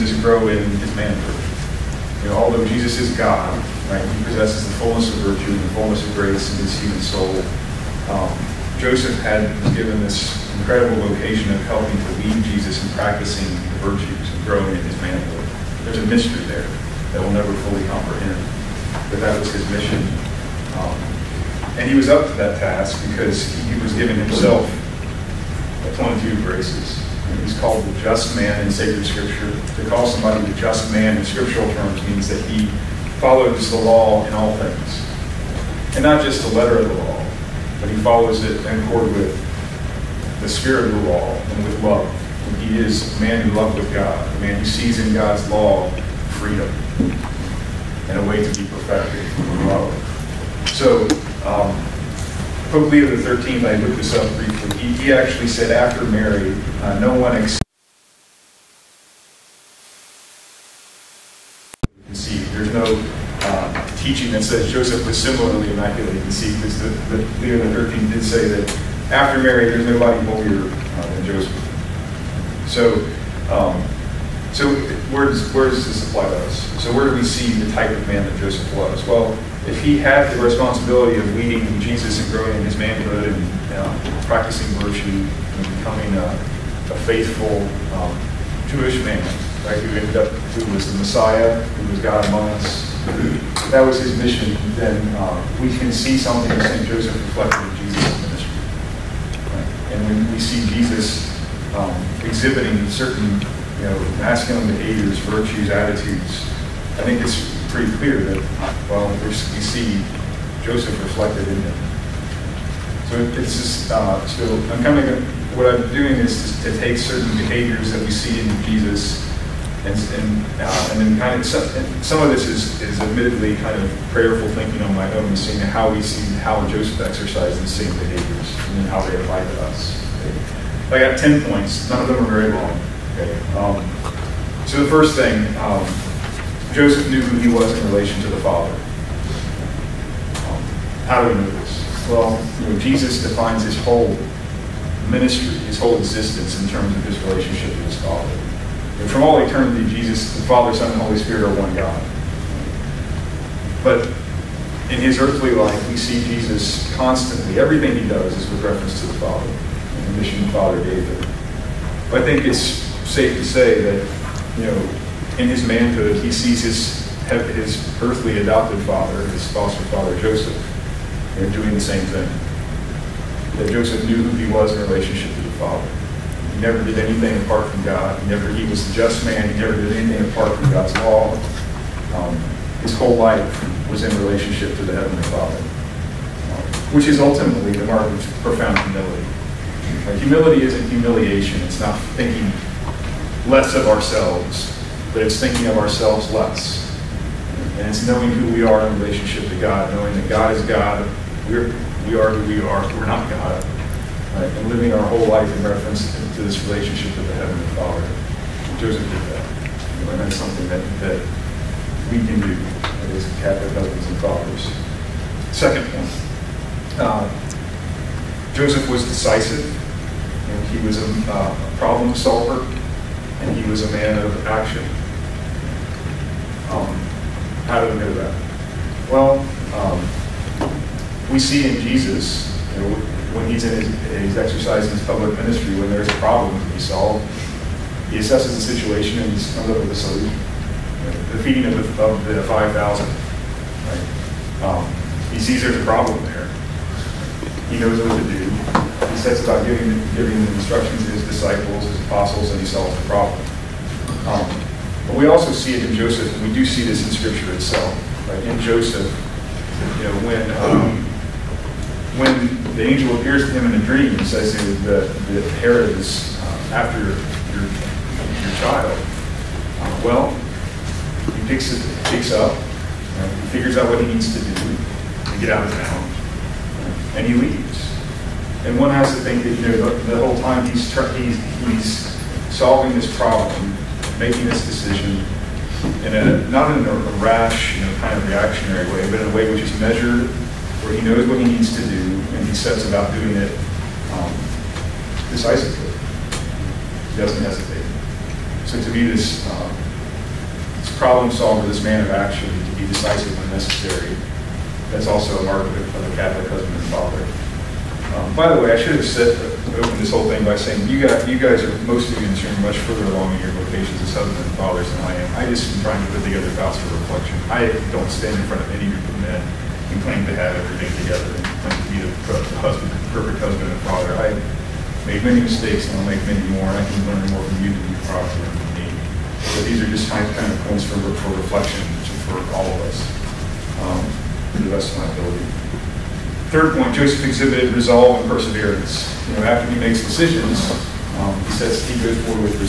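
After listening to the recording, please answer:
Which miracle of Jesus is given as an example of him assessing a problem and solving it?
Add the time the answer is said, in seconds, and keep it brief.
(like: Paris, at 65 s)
feeding of the 5,000, at 241 s.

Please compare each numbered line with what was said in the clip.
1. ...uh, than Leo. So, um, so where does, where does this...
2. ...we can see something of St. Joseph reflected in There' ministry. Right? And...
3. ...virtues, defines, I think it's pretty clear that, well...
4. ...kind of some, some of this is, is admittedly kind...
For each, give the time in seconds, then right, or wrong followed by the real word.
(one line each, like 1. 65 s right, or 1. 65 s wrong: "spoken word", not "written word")
1. 70 s wrong: "Joseph", not "Leo"
2. 95 s wrong: "Jesus", not "There"
3. 105 s wrong: "attitudes", not "defines"
4. 121 s right.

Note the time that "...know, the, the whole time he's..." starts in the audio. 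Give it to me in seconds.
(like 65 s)
279 s.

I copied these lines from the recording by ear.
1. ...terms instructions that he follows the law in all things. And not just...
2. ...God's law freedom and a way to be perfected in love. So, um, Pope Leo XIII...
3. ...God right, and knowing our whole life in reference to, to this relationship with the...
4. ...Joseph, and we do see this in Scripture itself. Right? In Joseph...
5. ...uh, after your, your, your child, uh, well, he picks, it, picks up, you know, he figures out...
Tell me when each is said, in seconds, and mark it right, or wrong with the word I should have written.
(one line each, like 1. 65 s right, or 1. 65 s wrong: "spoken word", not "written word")
1. 31 s wrong: "means", not "instructions"
2. 45 s right
3. 203 s wrong: "living", not "knowing"
4. 255 s right
5. 266 s right.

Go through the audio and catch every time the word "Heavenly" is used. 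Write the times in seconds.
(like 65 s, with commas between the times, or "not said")
184 s, 207 s.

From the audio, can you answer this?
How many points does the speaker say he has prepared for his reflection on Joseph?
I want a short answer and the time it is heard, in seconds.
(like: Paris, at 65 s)
10, at 131 s.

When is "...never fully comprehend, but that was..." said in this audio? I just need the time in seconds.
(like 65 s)
17 s.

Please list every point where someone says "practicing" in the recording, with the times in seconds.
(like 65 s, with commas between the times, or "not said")
12 s, 84 s.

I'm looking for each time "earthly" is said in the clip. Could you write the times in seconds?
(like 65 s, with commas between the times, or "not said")
155 s, 168 s.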